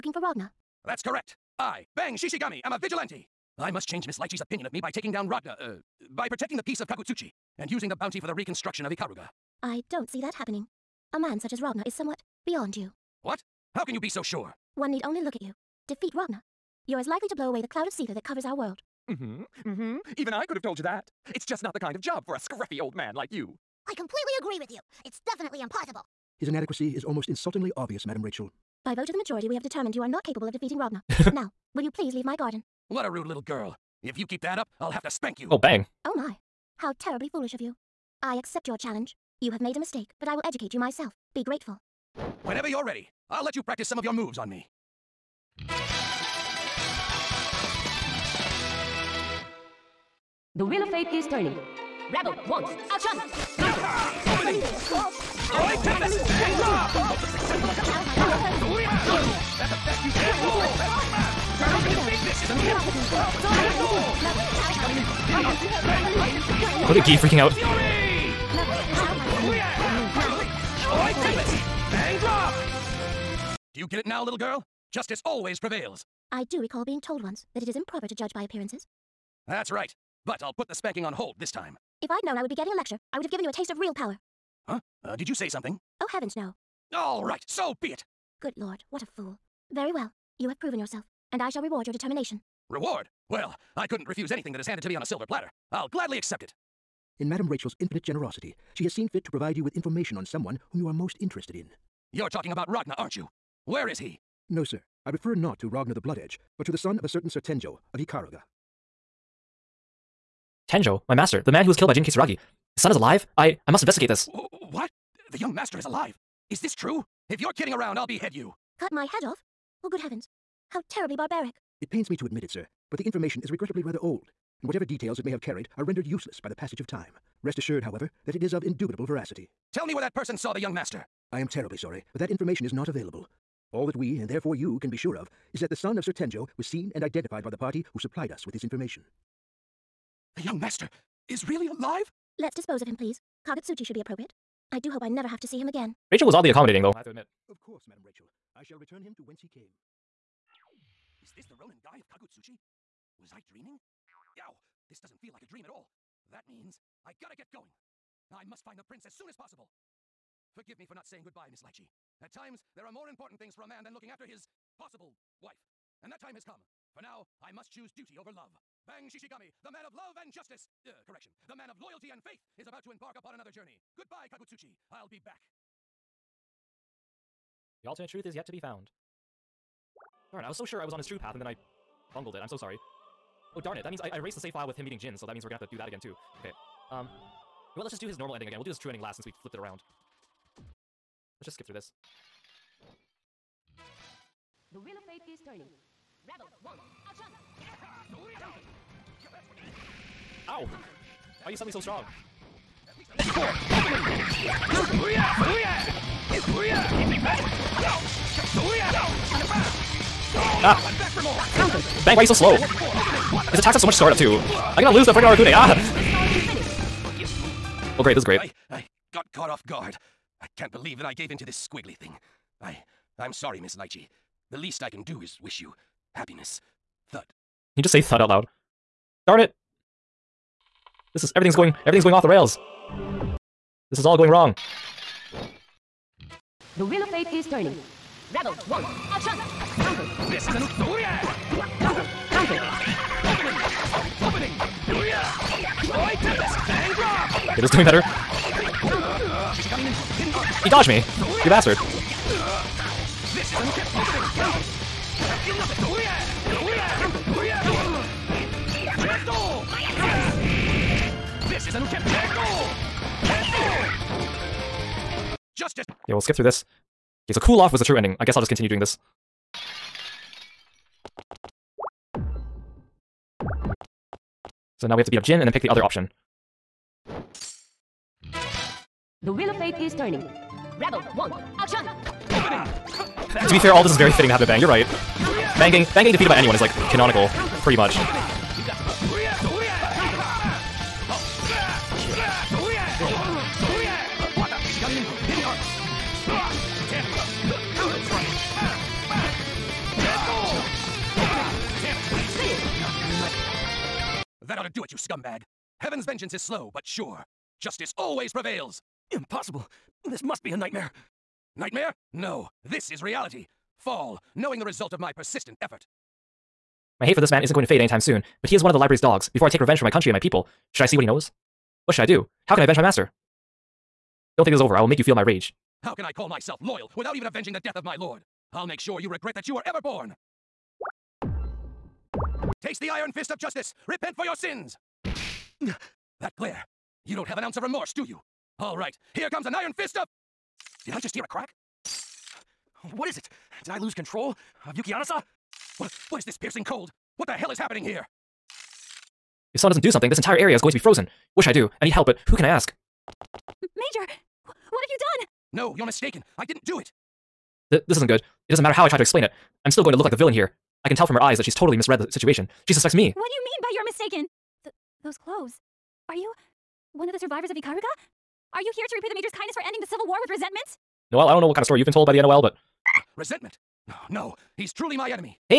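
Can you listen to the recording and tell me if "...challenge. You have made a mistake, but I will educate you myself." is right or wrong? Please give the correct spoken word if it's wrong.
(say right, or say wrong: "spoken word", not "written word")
right.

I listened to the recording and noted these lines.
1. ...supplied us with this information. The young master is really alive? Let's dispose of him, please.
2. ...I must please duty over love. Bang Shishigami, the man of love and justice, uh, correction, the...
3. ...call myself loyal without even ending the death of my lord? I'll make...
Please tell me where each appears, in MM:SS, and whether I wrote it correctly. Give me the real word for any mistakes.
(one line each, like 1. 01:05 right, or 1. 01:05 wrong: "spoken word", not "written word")
1. 02:17 right
2. 02:47 wrong: "choose", not "please"
3. 05:26 wrong: "avenging", not "ending".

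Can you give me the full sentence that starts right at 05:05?
Heaven's vengeance is slow, but sure.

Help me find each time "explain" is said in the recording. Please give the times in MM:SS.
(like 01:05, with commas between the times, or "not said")
05:59.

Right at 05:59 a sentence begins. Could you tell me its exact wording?
I'm still going to look like the villain here.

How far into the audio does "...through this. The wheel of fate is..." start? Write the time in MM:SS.
03:11.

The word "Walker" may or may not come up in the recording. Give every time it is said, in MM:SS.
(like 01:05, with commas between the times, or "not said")
not said.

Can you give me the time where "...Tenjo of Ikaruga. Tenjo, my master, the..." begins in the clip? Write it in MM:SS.
01:47.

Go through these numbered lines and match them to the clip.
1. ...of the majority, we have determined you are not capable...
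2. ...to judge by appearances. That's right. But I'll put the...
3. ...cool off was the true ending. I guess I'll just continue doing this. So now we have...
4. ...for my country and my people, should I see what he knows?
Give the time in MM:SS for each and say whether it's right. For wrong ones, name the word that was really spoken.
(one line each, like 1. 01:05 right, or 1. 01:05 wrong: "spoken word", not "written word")
1. 00:29 right
2. 01:18 right
3. 04:27 right
4. 05:19 right.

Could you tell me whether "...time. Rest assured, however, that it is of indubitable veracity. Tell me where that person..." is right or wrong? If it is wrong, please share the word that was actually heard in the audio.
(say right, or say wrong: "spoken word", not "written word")
right.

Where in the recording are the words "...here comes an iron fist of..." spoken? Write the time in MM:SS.
05:39.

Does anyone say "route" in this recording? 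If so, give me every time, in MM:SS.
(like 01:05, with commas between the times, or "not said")
not said.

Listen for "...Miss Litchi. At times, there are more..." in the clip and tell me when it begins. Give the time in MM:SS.
02:41.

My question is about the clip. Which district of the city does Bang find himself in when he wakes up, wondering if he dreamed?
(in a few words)
Ronin-gai.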